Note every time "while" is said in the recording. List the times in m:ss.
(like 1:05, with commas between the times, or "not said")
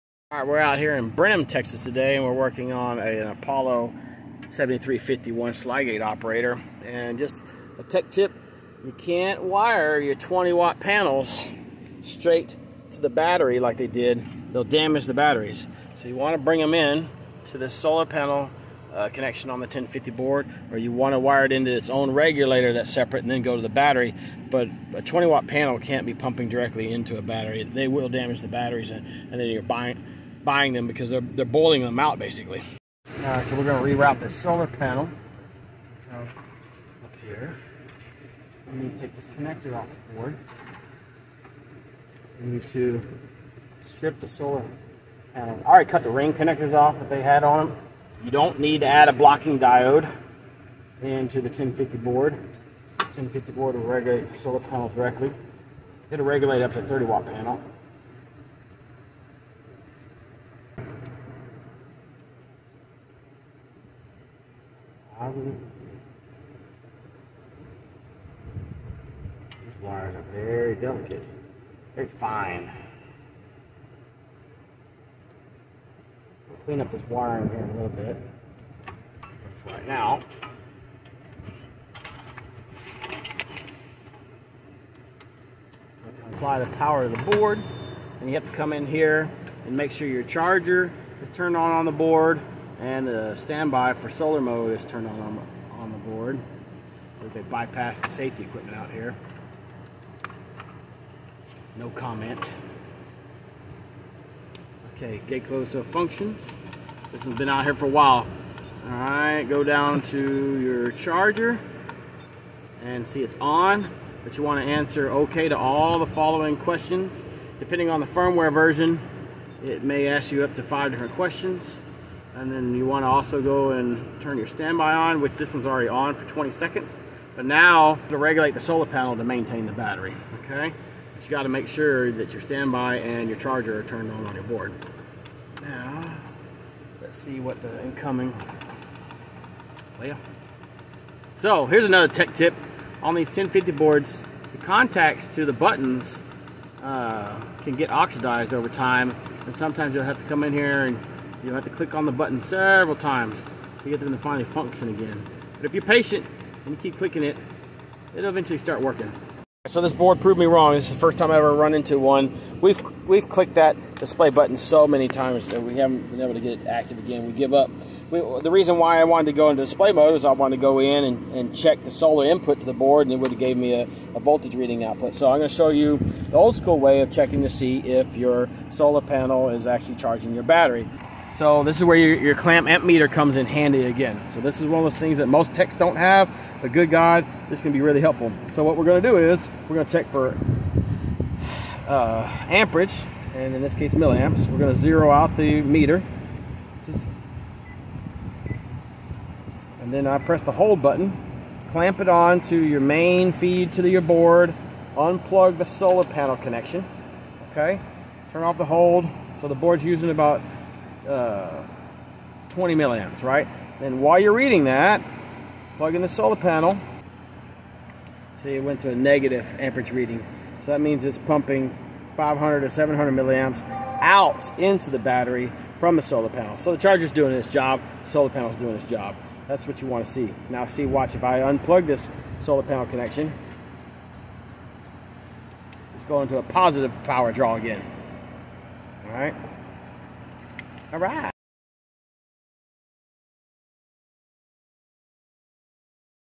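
1:47, 3:34.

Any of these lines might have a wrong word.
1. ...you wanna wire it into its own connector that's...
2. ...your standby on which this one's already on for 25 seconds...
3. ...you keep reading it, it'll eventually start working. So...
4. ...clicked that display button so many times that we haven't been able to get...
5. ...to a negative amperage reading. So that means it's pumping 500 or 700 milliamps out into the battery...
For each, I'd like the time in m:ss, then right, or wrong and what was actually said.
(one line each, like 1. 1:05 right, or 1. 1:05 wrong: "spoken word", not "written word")
1. 0:20 wrong: "regulator", not "connector"
2. 2:04 wrong: "20", not "25"
3. 2:36 wrong: "clicking", not "reading"
4. 2:43 right
5. 3:38 right.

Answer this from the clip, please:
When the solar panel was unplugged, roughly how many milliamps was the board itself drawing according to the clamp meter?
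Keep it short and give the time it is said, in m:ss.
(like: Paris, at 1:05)
20 milliamps, at 3:32.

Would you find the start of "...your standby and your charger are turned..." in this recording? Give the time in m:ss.
2:12.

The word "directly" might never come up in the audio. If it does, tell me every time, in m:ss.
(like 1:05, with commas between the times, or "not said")
0:26, 0:54.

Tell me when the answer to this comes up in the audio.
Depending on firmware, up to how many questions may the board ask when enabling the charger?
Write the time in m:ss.
2:00.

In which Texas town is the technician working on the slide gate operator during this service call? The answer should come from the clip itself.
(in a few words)
Brenham.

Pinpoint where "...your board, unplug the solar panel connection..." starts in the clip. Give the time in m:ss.
3:23.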